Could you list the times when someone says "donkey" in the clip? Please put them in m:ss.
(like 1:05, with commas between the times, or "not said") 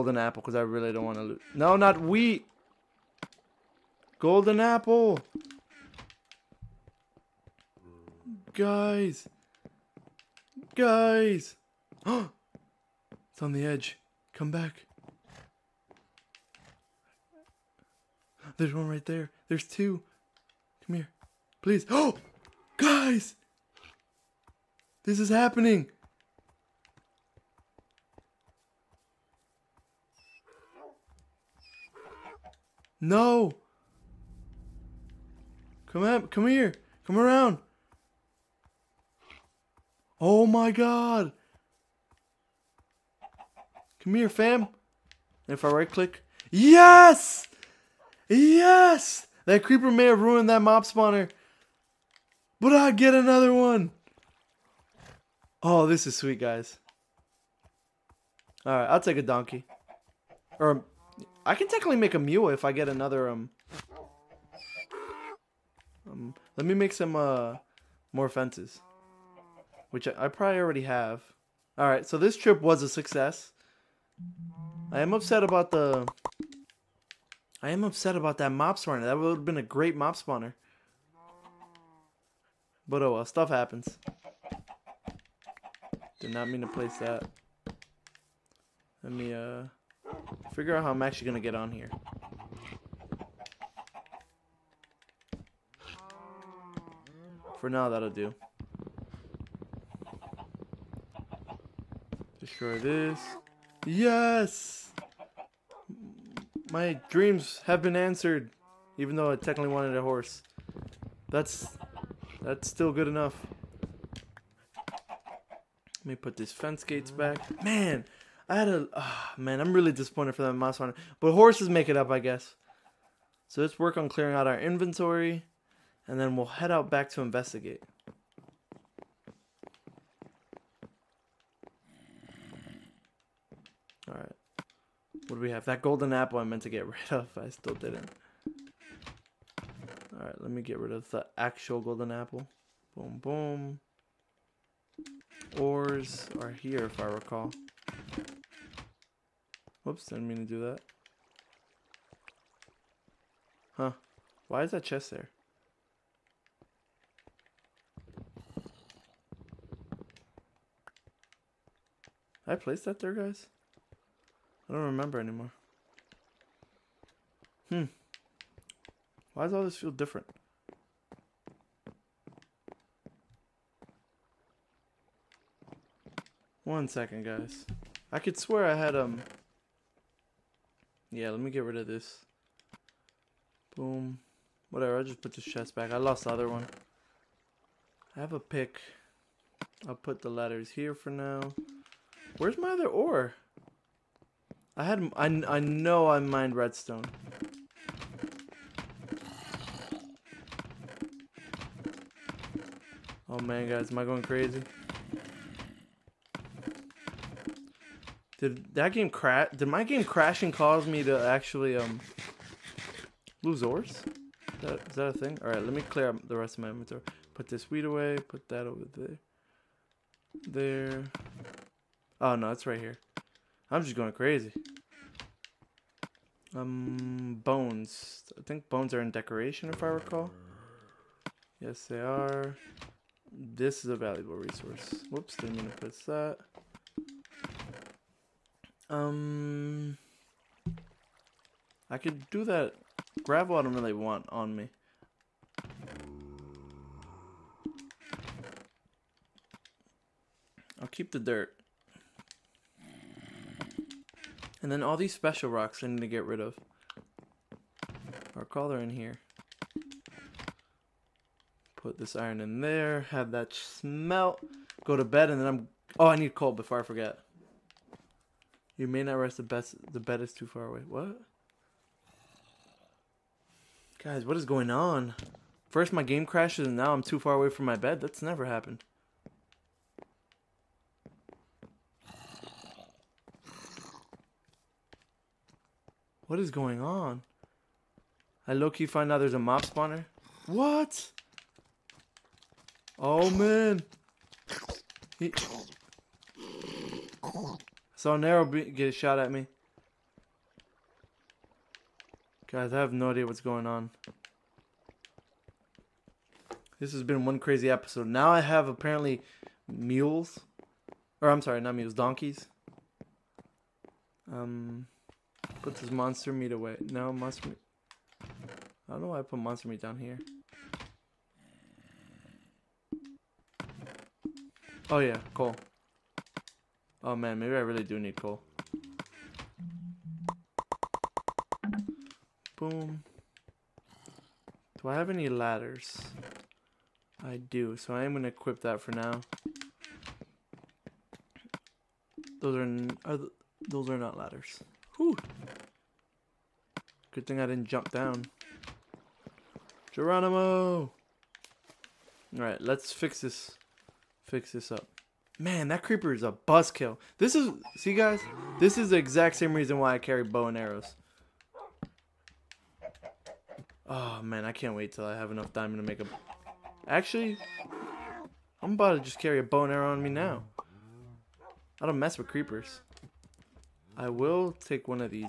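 0:59, 5:11.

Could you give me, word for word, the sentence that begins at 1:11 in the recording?
All right, so this trip was a success.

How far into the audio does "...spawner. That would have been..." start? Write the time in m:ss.
1:18.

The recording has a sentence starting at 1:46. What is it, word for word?
My dreams have been answered, even though I technically wanted a horse.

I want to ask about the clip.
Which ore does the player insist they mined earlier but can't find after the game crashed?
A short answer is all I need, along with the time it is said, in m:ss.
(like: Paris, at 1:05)
Redstone, at 3:16.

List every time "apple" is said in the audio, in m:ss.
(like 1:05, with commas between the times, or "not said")
0:00, 0:04, 2:16, 2:22.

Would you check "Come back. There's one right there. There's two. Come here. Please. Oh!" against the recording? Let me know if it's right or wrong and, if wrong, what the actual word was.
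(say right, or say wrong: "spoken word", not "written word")
right.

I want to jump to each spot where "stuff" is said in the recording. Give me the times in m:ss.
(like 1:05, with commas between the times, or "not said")
1:23.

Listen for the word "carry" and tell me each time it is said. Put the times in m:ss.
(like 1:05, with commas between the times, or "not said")
5:59, 6:09.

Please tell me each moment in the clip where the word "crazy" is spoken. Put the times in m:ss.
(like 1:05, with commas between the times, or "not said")
3:24, 3:44, 5:07.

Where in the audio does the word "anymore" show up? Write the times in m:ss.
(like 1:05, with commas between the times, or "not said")
2:45.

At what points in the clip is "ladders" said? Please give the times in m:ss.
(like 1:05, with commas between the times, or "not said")
3:10, 5:35, 5:44.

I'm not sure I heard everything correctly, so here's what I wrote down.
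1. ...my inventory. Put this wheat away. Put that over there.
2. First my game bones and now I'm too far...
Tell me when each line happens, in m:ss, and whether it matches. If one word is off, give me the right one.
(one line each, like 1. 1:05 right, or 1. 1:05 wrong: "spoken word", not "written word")
1. 3:36 right
2. 4:35 wrong: "crashes", not "bones".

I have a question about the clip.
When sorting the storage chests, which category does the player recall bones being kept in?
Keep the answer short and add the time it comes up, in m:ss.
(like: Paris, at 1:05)
Decoration, at 3:49.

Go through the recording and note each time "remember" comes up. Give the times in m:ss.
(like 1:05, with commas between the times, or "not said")
2:44.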